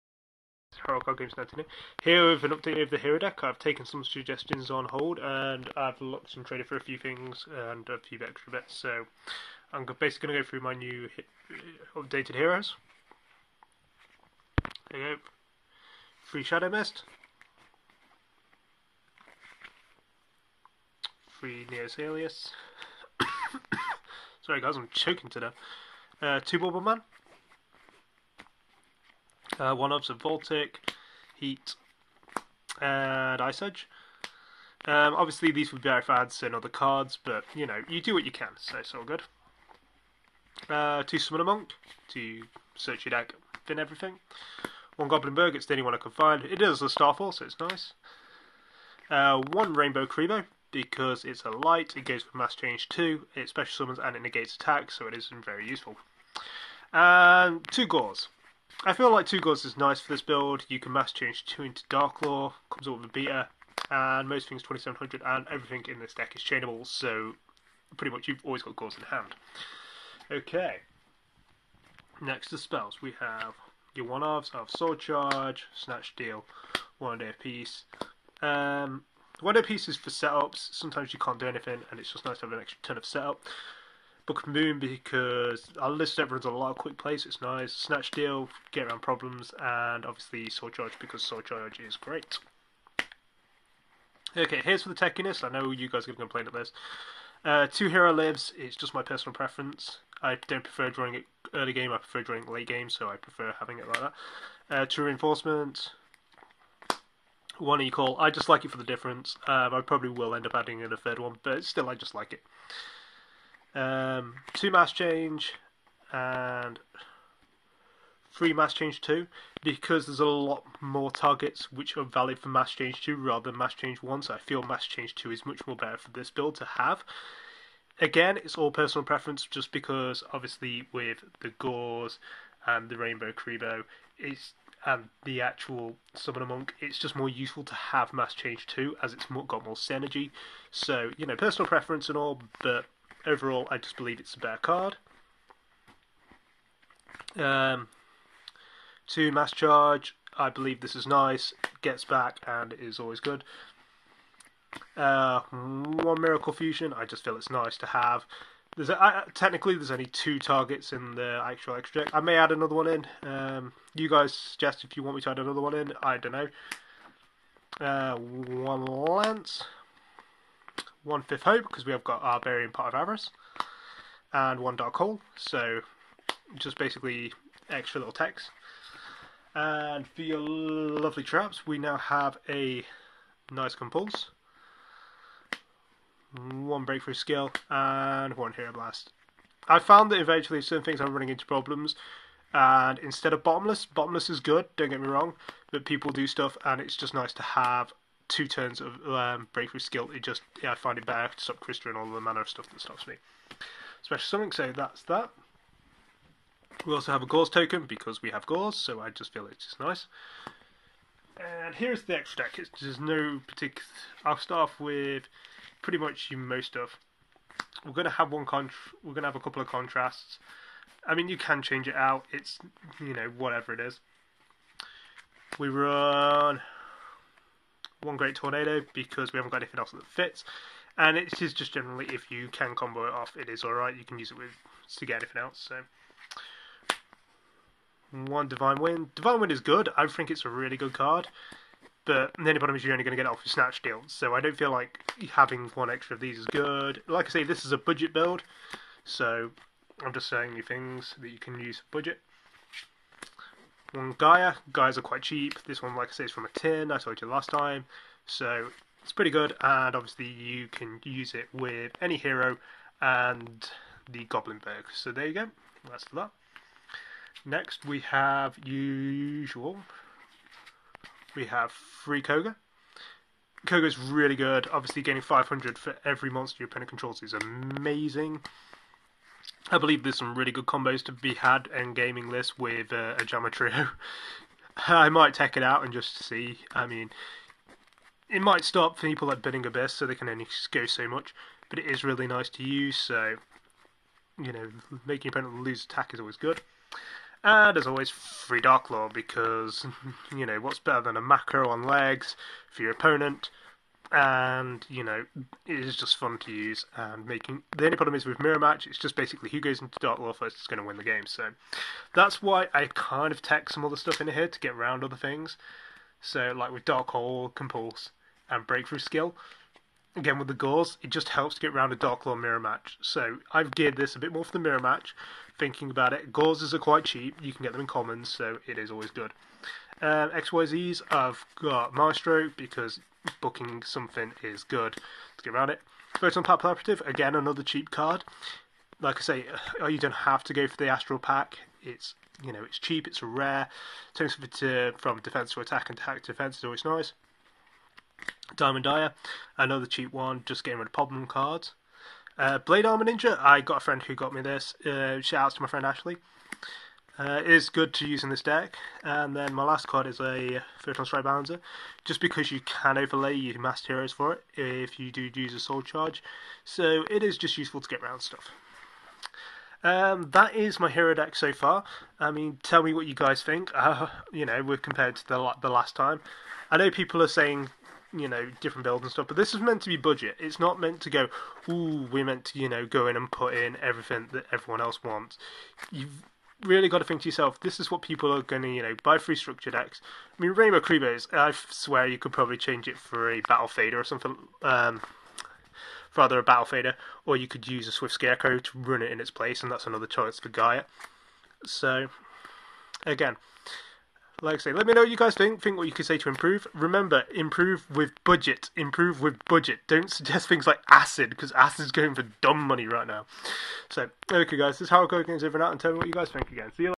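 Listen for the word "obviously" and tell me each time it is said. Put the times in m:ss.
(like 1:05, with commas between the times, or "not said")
0:35, 1:30, 2:10, 4:19, 4:34.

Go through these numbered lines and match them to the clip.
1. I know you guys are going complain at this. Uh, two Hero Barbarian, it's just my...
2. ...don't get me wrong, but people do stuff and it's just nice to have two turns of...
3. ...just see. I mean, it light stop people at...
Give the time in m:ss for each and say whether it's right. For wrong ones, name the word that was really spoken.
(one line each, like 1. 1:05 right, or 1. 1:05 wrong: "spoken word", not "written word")
1. 1:35 wrong: "Lives", not "Barbarian"
2. 3:14 right
3. 4:45 wrong: "might", not "light".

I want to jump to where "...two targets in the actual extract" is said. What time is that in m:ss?
2:40.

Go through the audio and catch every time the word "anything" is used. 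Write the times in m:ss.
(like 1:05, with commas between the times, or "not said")
1:21, 3:49, 3:55.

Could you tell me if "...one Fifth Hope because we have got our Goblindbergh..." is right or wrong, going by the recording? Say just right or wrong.
wrong.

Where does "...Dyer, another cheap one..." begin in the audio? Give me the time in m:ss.
5:48.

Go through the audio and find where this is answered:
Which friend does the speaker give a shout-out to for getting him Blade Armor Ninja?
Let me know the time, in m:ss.
5:55.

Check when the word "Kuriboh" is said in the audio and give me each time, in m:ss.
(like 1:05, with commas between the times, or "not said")
0:50, 2:13.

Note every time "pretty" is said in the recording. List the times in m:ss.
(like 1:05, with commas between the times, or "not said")
1:07, 3:35, 4:19.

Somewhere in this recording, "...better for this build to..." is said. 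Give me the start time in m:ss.
2:05.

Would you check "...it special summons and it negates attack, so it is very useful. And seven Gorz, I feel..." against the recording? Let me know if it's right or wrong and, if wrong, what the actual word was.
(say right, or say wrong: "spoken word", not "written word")
wrong: "two", not "seven".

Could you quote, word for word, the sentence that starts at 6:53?
So, okay, guys, this is how it goes over and out, and tell me what you guys think again.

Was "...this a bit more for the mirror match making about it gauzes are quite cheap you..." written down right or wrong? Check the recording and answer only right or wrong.
wrong.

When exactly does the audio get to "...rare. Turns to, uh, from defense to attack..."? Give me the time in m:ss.
5:43.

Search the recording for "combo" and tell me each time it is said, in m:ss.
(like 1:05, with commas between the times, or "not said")
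3:52, 4:40.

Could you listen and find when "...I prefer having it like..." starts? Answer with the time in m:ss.
1:43.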